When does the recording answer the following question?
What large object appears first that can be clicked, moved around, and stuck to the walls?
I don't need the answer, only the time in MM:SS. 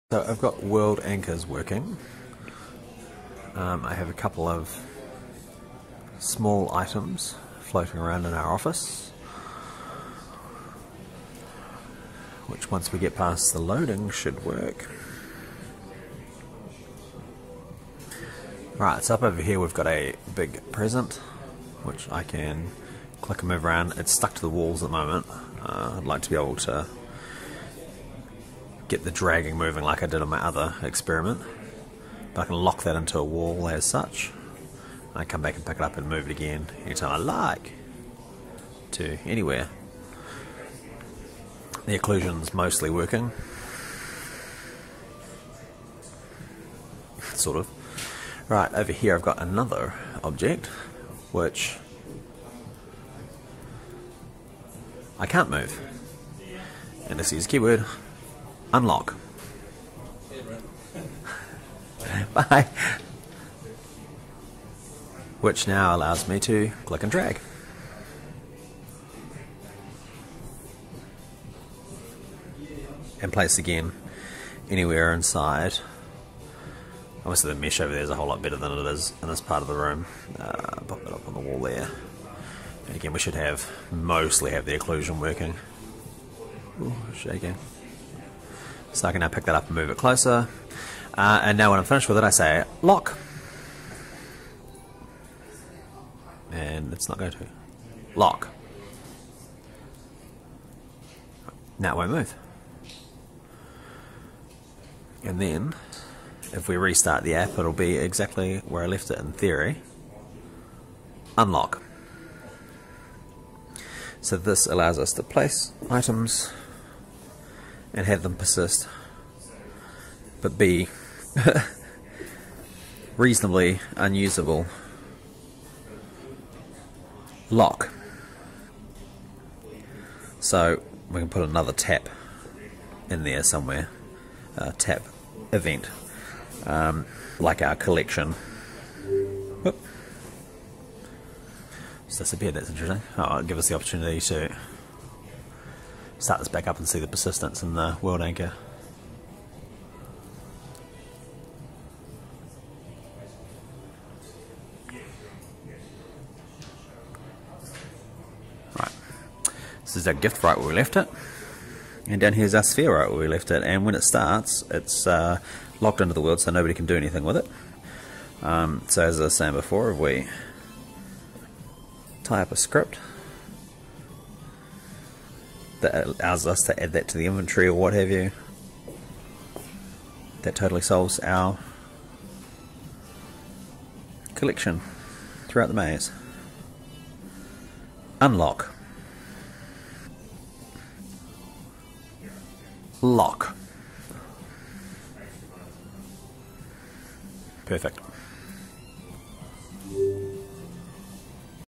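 00:20.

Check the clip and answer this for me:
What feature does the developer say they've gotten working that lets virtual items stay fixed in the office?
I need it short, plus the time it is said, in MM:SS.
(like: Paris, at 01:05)
World anchors, at 00:00.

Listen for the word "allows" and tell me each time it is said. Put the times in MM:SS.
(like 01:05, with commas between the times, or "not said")
01:05, 01:54, 02:56.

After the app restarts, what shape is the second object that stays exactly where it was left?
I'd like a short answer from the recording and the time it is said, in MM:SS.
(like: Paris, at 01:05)
Sphere, at 02:42.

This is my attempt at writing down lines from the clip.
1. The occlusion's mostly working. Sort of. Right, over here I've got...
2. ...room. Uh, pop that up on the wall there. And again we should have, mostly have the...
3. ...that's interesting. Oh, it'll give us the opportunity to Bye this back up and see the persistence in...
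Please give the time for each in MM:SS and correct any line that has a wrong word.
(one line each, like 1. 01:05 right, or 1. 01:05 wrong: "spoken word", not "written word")
1. 00:41 right
2. 01:19 right
3. 02:22 wrong: "Sat", not "Bye".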